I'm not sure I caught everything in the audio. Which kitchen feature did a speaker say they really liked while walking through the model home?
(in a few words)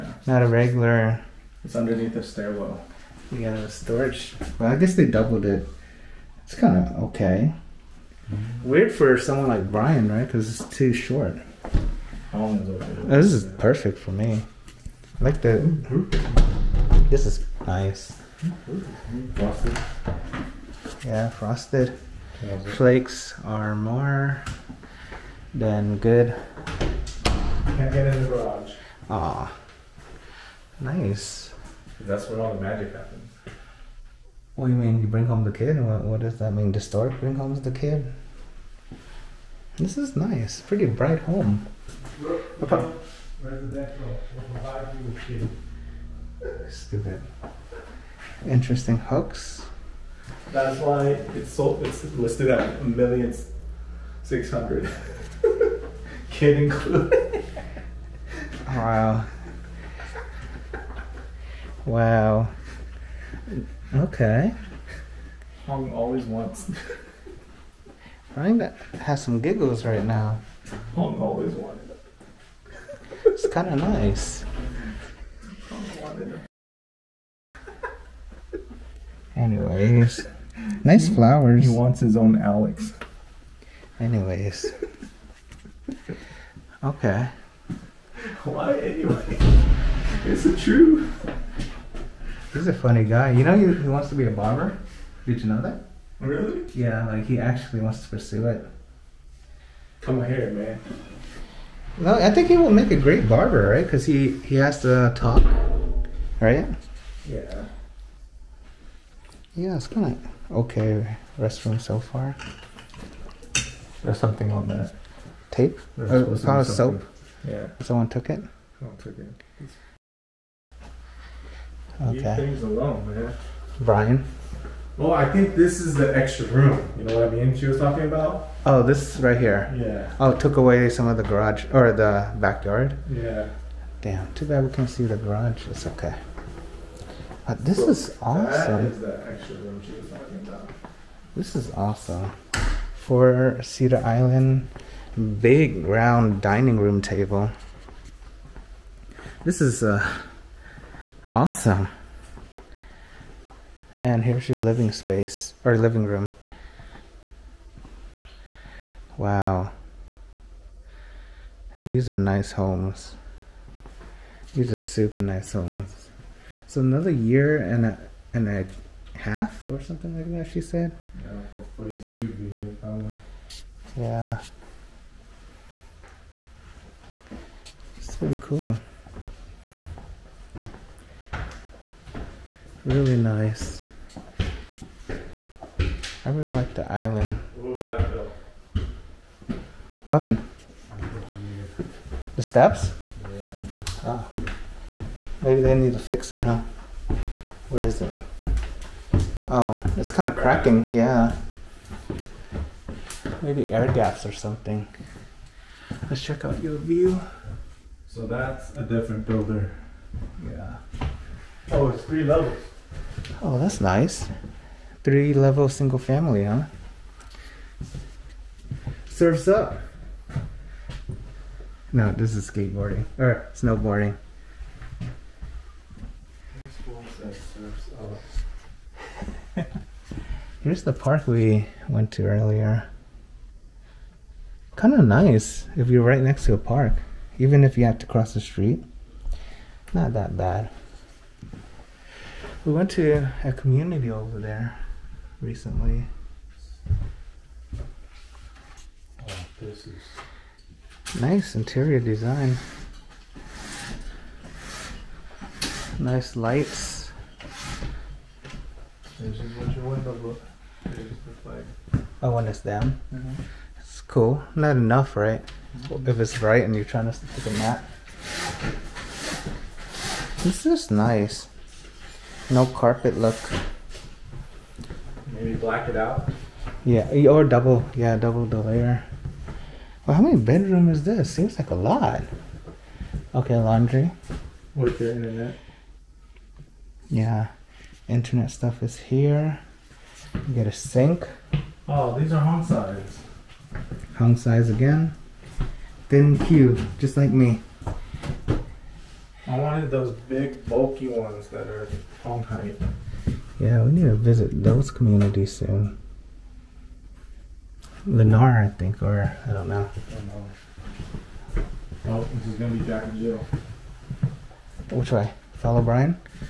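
The island.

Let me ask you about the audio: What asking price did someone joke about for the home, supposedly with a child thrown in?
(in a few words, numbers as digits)
$1,600,000.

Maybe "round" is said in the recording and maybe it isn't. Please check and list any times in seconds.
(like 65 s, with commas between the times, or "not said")
145 s.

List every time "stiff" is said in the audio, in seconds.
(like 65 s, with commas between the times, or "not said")
not said.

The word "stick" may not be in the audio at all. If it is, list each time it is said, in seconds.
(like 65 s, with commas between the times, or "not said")
267 s.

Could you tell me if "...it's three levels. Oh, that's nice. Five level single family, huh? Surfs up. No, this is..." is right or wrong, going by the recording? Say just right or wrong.
wrong.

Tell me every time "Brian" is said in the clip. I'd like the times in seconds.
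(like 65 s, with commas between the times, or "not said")
9 s, 123 s, 315 s.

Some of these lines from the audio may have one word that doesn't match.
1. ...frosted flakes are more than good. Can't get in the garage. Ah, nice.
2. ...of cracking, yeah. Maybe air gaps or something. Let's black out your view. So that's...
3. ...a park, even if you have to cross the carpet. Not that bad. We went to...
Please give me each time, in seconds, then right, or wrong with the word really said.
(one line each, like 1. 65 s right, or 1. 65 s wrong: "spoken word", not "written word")
1. 21 s right
2. 200 s wrong: "check", not "black"
3. 236 s wrong: "street", not "carpet".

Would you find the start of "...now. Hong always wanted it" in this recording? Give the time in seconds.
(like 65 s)
70 s.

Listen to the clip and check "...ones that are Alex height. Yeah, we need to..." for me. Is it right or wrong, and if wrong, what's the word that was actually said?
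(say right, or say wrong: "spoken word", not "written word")
wrong: "Hong", not "Alex".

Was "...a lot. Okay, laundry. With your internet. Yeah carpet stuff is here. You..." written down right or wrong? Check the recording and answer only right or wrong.
wrong.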